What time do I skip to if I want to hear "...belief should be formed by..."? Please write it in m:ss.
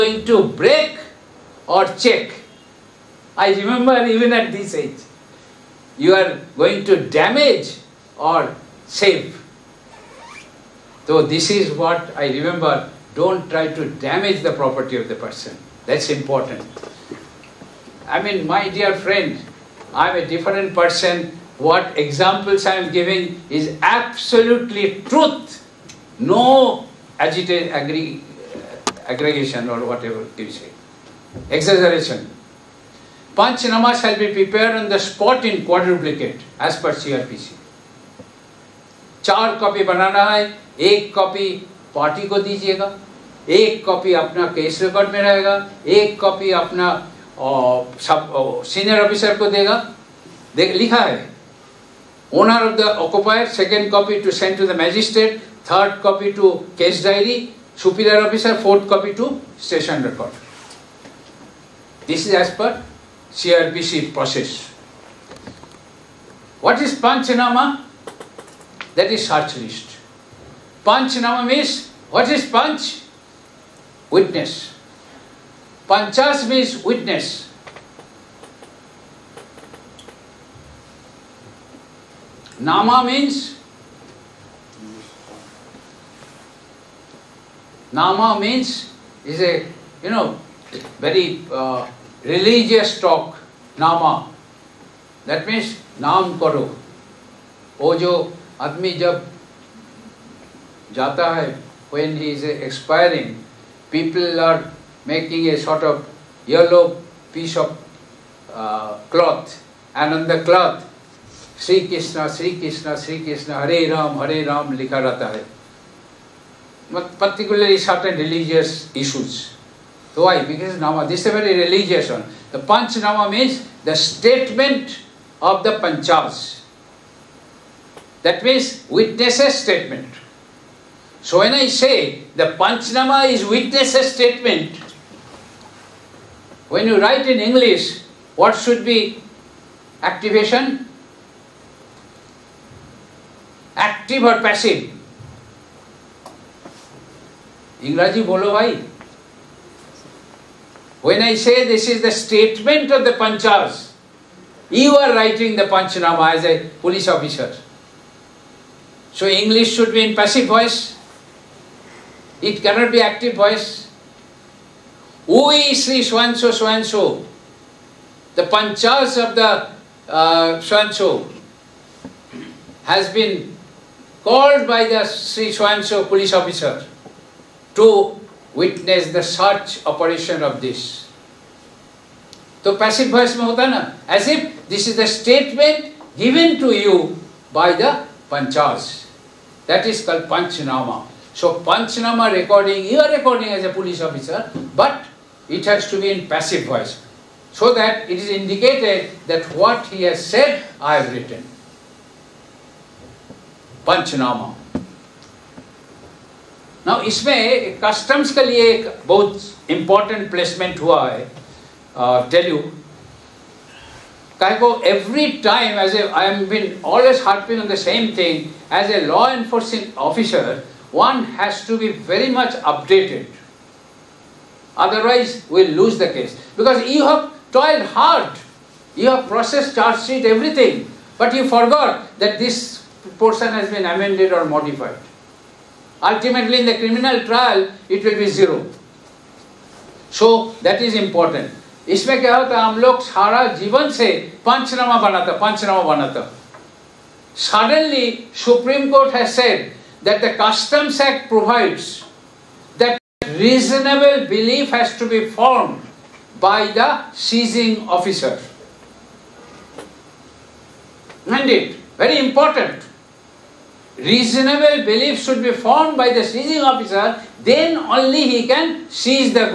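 4:24.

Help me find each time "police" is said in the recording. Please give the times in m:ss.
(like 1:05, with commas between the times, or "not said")
2:36, 2:56, 3:13.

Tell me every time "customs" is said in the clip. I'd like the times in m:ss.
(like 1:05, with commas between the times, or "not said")
3:27, 4:10.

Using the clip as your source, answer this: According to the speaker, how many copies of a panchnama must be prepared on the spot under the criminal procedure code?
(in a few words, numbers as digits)
Quadruplicate (4 copies).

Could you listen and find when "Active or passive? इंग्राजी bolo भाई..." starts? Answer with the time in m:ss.
2:23.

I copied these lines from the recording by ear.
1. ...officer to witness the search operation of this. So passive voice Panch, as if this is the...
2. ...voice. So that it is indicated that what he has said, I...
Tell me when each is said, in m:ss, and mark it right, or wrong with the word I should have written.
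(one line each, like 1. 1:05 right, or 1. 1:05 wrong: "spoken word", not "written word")
1. 2:56 wrong: "Mahatana", not "Panch"
2. 3:16 right.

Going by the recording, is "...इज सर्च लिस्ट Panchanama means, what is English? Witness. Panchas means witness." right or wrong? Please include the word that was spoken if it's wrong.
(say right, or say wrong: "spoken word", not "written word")
wrong: "Panch", not "English".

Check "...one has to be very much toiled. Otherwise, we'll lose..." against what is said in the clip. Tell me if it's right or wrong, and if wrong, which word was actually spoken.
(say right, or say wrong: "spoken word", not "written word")
wrong: "updated", not "toiled".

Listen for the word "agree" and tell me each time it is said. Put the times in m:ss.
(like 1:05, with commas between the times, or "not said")
0:27.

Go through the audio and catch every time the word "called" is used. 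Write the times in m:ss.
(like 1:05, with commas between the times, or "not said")
2:54, 3:10.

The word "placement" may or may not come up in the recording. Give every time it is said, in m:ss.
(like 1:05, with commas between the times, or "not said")
3:30.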